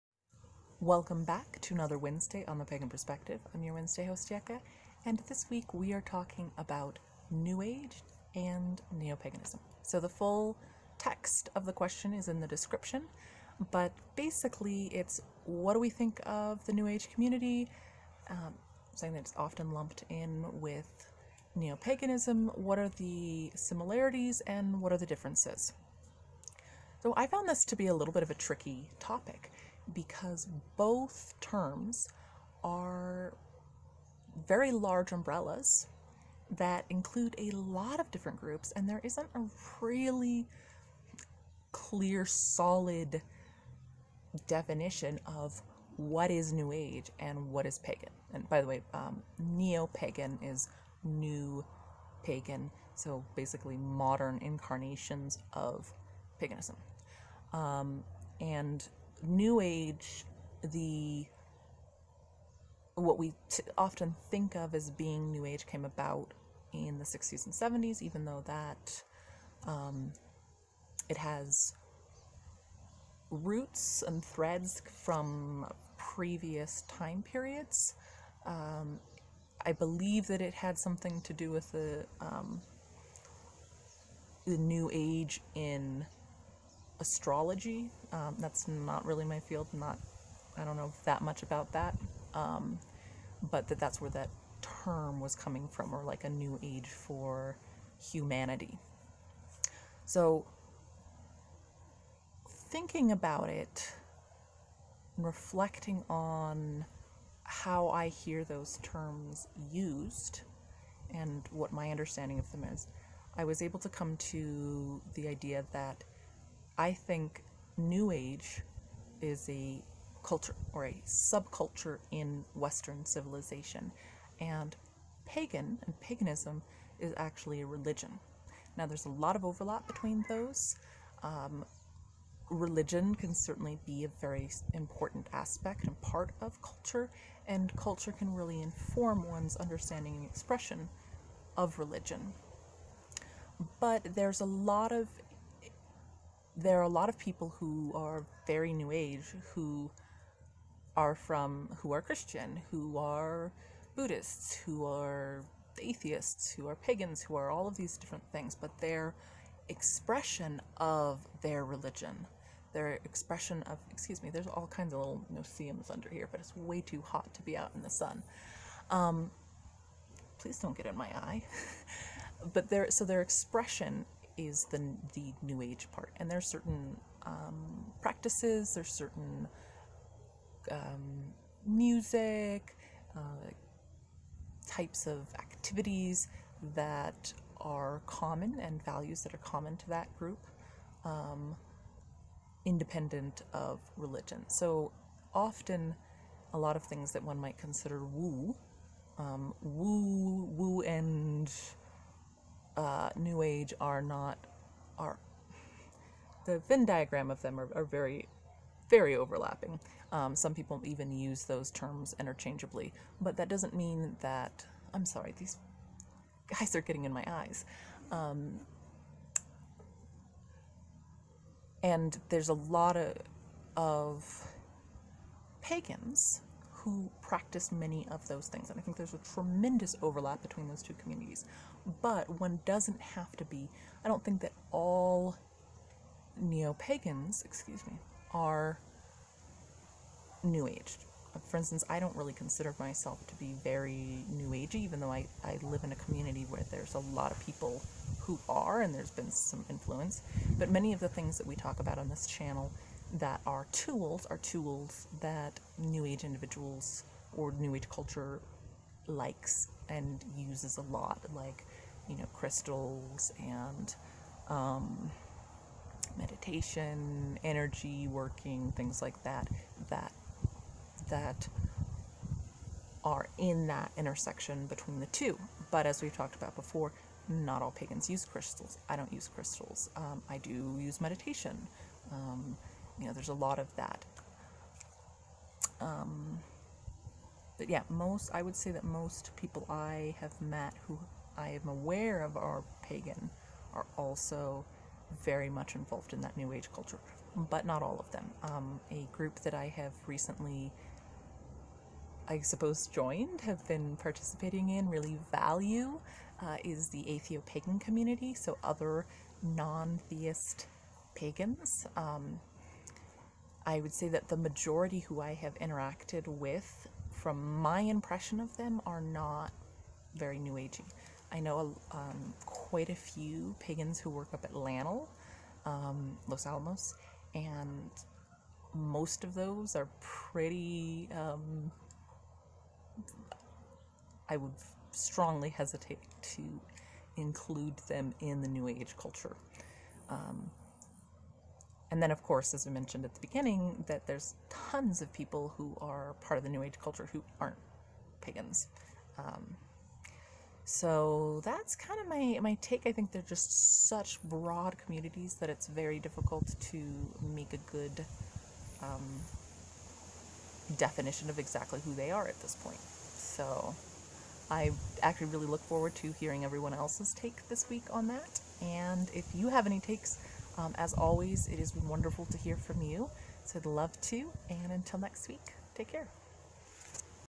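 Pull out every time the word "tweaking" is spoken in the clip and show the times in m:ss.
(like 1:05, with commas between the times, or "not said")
not said.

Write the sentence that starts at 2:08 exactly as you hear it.
Now, there's a lot of overlap between those.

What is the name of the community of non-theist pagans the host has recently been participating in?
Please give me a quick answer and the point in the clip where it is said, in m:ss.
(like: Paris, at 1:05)
Atheopagan, at 5:07.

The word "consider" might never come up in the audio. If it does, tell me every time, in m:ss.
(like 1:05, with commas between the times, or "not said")
3:17, 4:02.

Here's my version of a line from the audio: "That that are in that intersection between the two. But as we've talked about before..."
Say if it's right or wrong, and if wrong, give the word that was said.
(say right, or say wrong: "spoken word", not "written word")
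right.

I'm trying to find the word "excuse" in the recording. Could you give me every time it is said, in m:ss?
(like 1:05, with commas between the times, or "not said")
2:43, 3:57.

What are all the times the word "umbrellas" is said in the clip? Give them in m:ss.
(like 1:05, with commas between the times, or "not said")
0:35.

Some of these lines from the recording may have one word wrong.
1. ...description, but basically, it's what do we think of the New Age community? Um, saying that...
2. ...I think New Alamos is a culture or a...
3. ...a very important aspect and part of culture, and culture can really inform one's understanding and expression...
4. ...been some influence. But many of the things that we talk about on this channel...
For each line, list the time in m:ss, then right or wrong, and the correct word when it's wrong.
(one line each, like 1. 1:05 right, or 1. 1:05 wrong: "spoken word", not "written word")
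1. 0:12 right
2. 1:56 wrong: "Age", not "Alamos"
3. 2:14 right
4. 4:09 right.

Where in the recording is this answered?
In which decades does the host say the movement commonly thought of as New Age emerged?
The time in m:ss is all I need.
1:07.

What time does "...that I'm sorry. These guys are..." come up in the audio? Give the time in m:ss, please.
3:34.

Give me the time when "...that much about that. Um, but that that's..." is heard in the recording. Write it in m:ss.
1:31.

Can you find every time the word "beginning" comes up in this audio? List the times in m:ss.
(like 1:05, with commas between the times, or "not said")
5:43.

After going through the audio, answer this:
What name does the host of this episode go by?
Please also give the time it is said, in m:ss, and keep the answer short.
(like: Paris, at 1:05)
Yucca, at 0:04.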